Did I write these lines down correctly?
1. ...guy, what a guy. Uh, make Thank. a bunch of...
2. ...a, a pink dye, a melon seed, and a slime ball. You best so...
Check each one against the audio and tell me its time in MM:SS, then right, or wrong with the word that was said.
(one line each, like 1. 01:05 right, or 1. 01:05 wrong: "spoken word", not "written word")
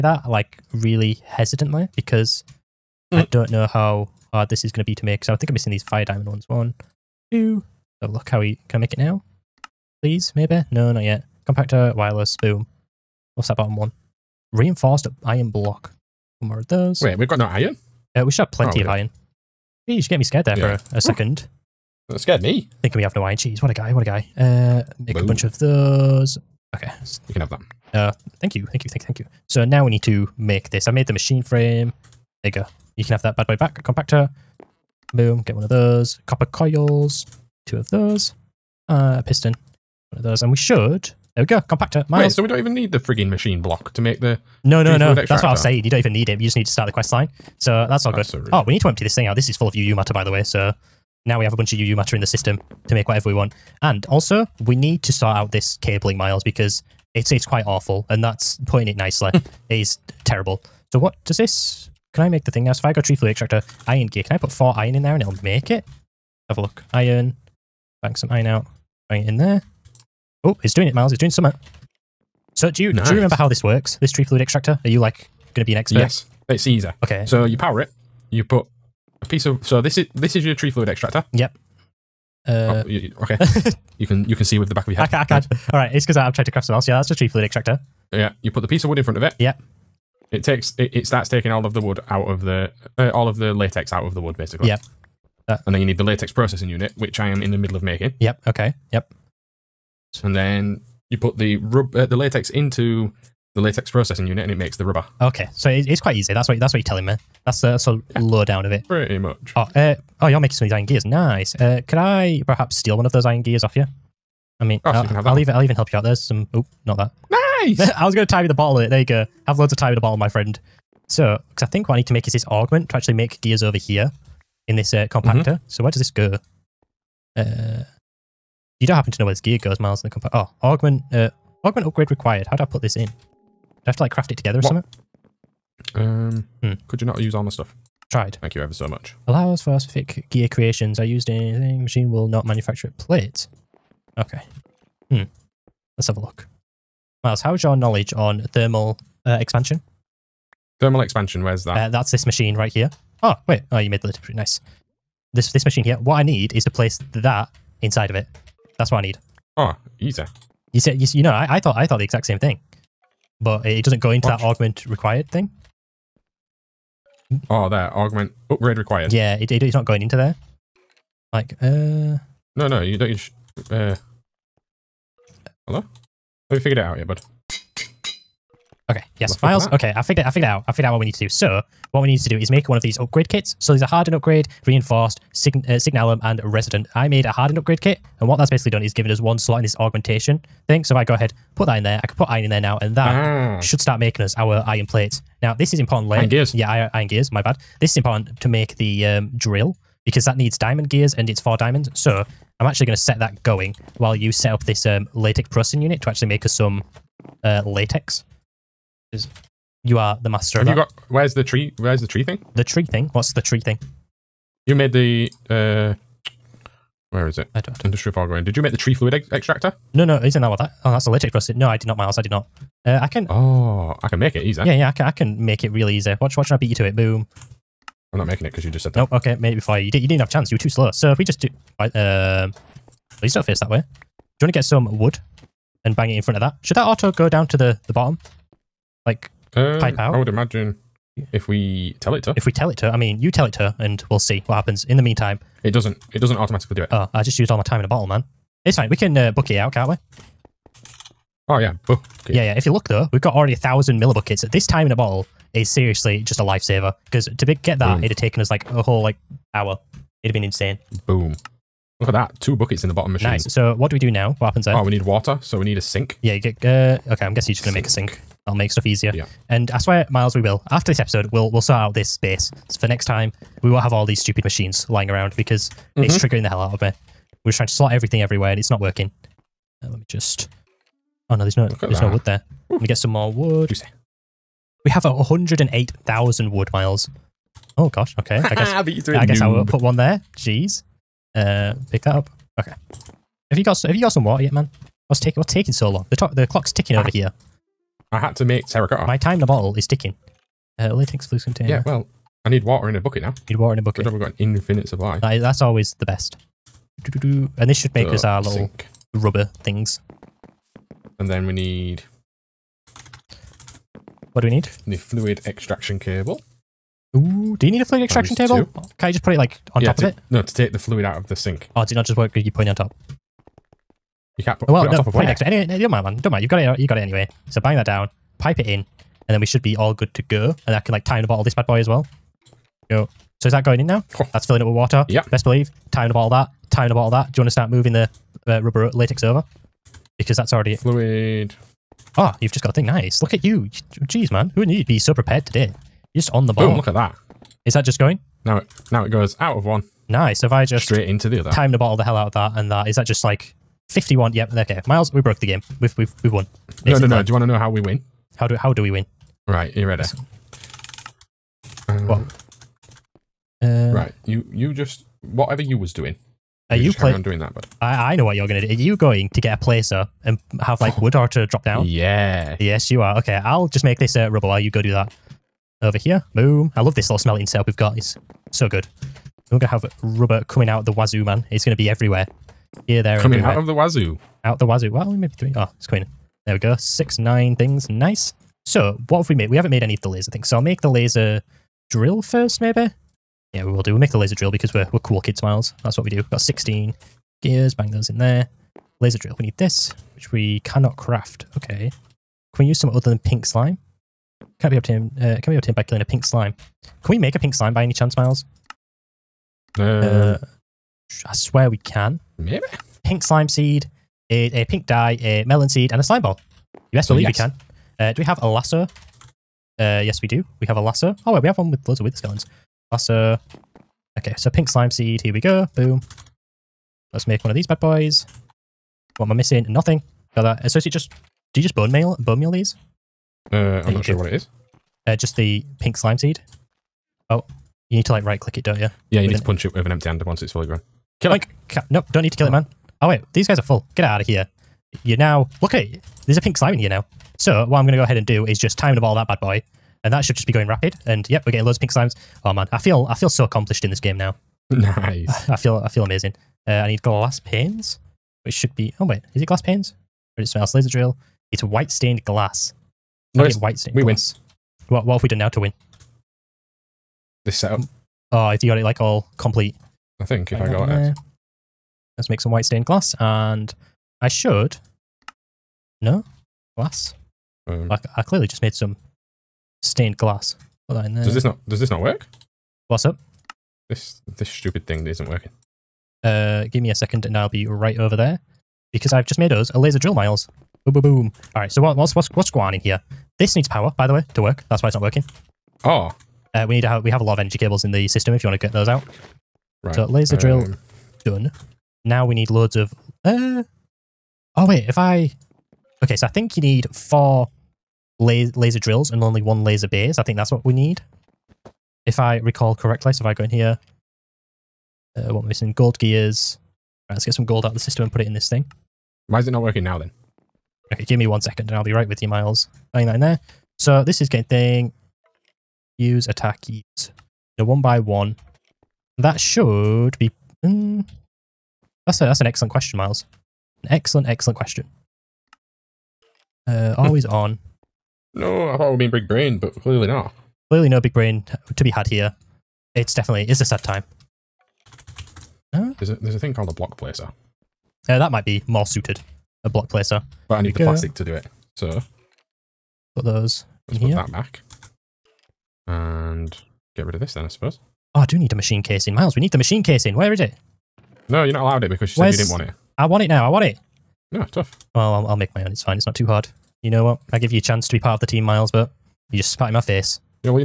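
1. 00:23 wrong: "Boom", not "Thank"
2. 06:54 right.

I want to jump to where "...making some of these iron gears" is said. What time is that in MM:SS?
01:50.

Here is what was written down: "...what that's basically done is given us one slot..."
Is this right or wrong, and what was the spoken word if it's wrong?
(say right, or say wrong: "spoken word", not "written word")
right.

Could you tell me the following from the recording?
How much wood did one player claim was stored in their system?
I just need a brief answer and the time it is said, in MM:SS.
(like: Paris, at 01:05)
108,000, at 04:45.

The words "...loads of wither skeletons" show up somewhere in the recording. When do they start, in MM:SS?
07:01.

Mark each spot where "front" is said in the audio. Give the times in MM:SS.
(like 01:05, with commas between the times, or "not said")
01:29, 03:56.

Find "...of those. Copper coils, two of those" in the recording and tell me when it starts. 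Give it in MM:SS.
00:35.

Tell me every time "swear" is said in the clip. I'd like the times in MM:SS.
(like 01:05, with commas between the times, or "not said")
04:29, 06:51.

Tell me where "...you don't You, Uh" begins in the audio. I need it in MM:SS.
02:52.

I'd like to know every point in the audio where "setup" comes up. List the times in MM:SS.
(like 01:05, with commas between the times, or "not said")
06:17, 07:47.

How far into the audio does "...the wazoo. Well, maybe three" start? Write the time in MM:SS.
06:24.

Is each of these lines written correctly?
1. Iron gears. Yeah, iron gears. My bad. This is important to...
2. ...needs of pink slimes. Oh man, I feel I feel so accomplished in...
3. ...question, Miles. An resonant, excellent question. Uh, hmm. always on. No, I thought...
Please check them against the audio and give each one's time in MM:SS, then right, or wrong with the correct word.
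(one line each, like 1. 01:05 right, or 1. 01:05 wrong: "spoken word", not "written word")
1. 03:16 right
2. 07:31 wrong: "loads", not "needs"
3. 08:52 wrong: "excellent", not "resonant".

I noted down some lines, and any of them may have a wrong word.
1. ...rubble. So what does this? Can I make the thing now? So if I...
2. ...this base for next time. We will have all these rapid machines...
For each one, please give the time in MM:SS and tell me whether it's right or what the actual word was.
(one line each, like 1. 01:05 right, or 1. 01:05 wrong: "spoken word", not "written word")
1. 01:00 wrong: "terrible", not "rubble"
2. 04:31 wrong: "stupid", not "rapid".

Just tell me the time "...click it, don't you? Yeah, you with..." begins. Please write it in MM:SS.
07:18.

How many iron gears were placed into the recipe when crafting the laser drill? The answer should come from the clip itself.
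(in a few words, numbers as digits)
16.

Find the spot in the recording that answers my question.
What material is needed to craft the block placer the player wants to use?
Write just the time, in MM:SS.
09:10.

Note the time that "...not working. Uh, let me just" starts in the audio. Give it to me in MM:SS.
04:38.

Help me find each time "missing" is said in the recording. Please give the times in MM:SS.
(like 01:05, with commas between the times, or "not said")
00:05, 07:09, 08:35.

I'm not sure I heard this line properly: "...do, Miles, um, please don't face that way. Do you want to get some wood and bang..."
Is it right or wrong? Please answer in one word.
wrong.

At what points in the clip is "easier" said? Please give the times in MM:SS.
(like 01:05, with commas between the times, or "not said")
01:16, 04:28.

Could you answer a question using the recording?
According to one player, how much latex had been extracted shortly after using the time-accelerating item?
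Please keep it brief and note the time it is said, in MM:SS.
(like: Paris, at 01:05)
1000 millibuckets, at 04:13.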